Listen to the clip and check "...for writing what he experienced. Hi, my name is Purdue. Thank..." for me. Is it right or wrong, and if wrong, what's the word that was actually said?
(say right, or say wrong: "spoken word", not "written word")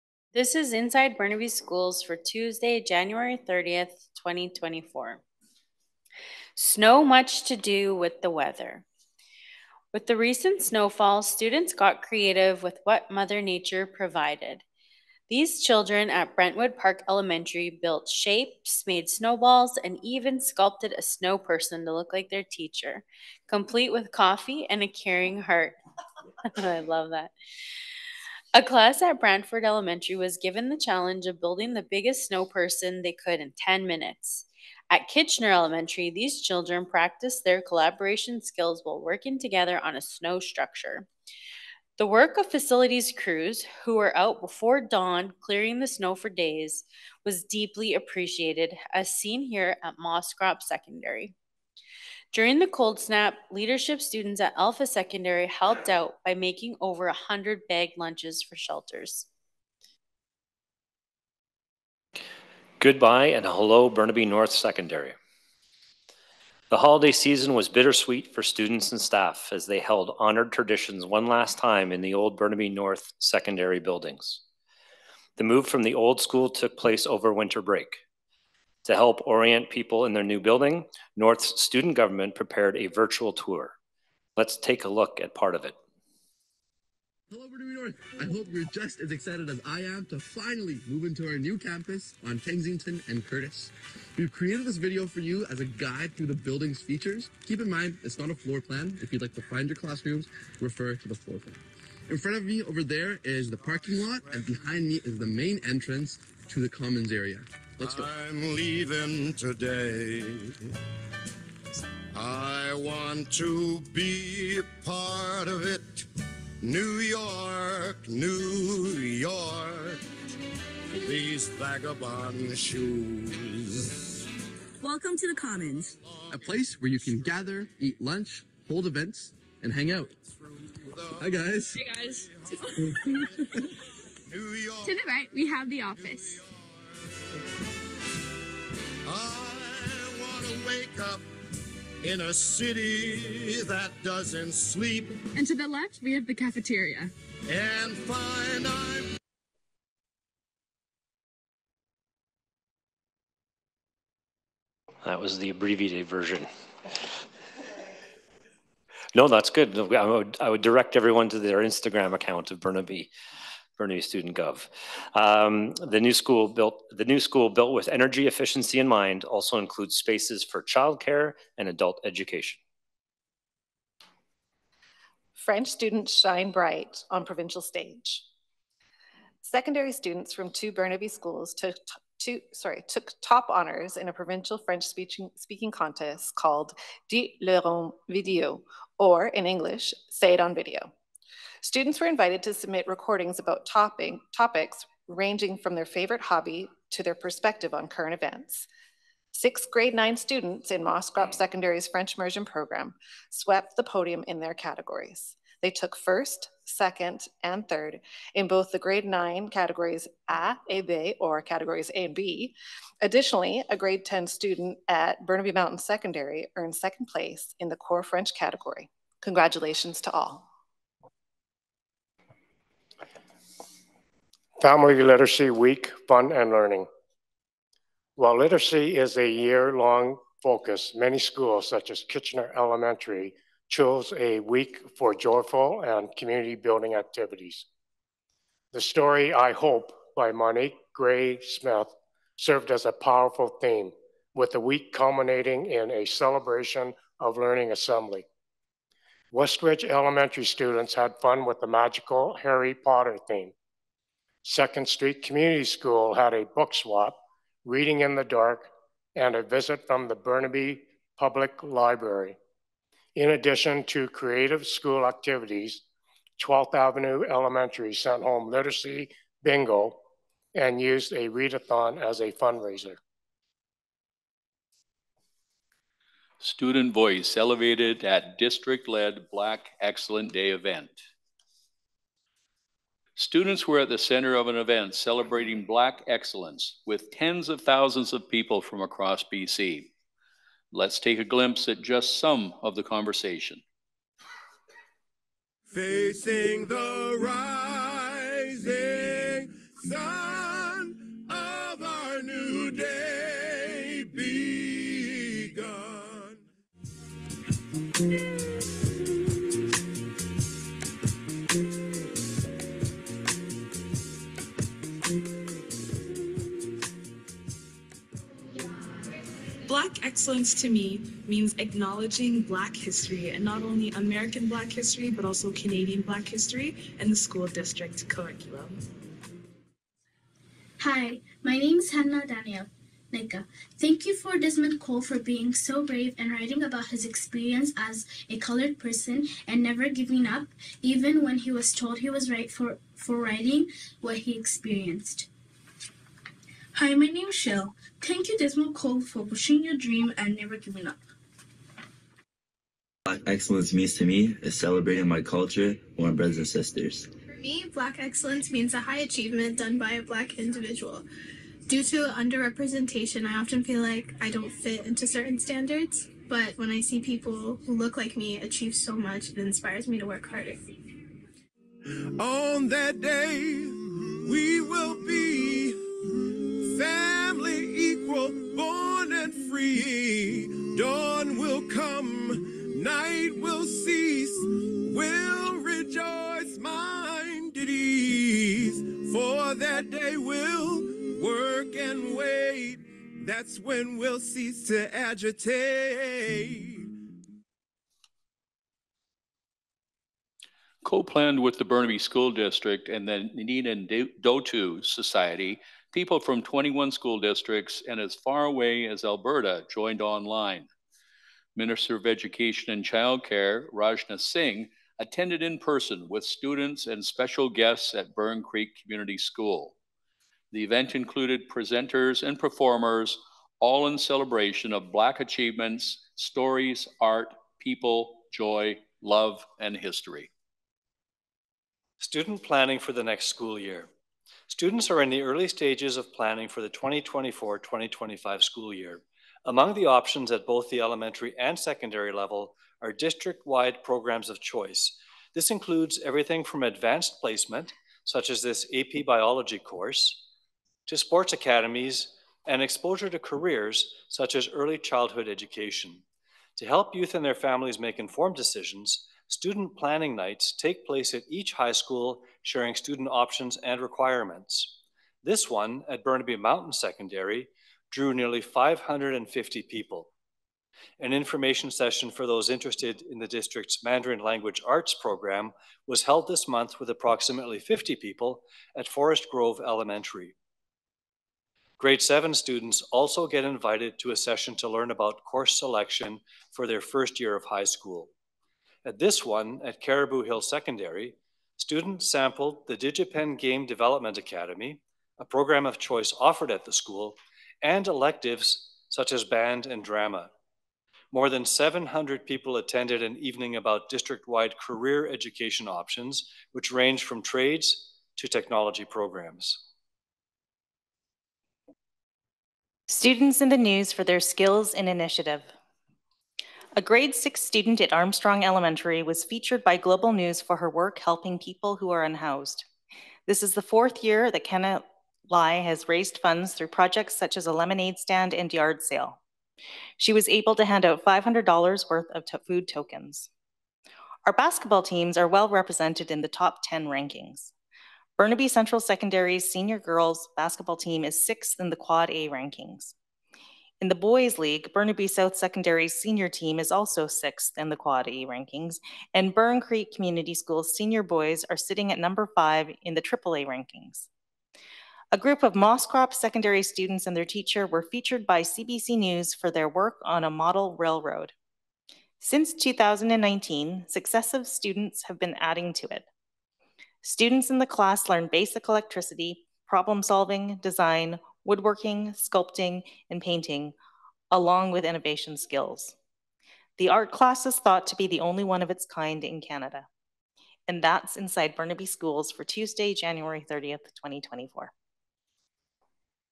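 wrong: "Shell", not "Purdue".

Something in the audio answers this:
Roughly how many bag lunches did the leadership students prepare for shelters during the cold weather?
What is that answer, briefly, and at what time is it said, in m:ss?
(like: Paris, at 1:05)
over 100, at 0:56.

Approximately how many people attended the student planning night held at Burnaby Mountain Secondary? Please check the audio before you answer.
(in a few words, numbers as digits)
nearly 550.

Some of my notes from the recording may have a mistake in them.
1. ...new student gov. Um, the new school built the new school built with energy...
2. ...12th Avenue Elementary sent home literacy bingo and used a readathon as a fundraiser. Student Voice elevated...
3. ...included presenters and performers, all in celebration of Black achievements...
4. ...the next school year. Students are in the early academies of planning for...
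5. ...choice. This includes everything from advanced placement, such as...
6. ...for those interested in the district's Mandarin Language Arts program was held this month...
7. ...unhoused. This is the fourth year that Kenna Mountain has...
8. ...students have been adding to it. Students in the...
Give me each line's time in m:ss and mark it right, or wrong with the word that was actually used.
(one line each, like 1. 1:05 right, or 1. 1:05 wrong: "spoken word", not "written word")
1. 2:43 right
2. 4:26 right
3. 7:00 right
4. 7:12 wrong: "stages", not "academies"
5. 7:24 right
6. 7:52 right
7. 8:42 wrong: "Lai", not "Mountain"
8. 9:24 right.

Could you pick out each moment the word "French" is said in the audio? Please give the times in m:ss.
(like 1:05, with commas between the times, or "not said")
2:55, 3:04, 3:21, 3:38.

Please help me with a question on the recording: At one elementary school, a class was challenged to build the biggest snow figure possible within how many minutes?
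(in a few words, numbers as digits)
10 minutes.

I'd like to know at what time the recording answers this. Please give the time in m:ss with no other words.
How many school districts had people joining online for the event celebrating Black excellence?
6:46.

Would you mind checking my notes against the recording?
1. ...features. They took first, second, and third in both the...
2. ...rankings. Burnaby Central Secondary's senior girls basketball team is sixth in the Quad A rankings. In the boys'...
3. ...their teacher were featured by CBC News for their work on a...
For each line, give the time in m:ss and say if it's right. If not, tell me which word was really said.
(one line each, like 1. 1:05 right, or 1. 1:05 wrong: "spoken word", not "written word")
1. 3:24 wrong: "categories", not "features"
2. 8:56 right
3. 9:17 right.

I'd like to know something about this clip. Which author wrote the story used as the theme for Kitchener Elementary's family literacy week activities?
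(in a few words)
Monique Gray Smith.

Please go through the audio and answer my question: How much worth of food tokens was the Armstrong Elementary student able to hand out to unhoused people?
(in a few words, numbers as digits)
$500.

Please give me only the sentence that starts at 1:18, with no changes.
To help orient people in their new building, North's student government prepared a virtual tour.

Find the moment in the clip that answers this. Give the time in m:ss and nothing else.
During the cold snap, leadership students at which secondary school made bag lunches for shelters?
0:54.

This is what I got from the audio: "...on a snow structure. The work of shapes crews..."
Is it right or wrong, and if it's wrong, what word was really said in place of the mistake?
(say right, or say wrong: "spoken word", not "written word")
wrong: "facilities", not "shapes".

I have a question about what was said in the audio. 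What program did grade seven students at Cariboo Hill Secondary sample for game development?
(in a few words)
DigiPen Game Development Academy.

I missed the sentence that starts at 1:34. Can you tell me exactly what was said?
We've created this video for you as a guide through the building's features.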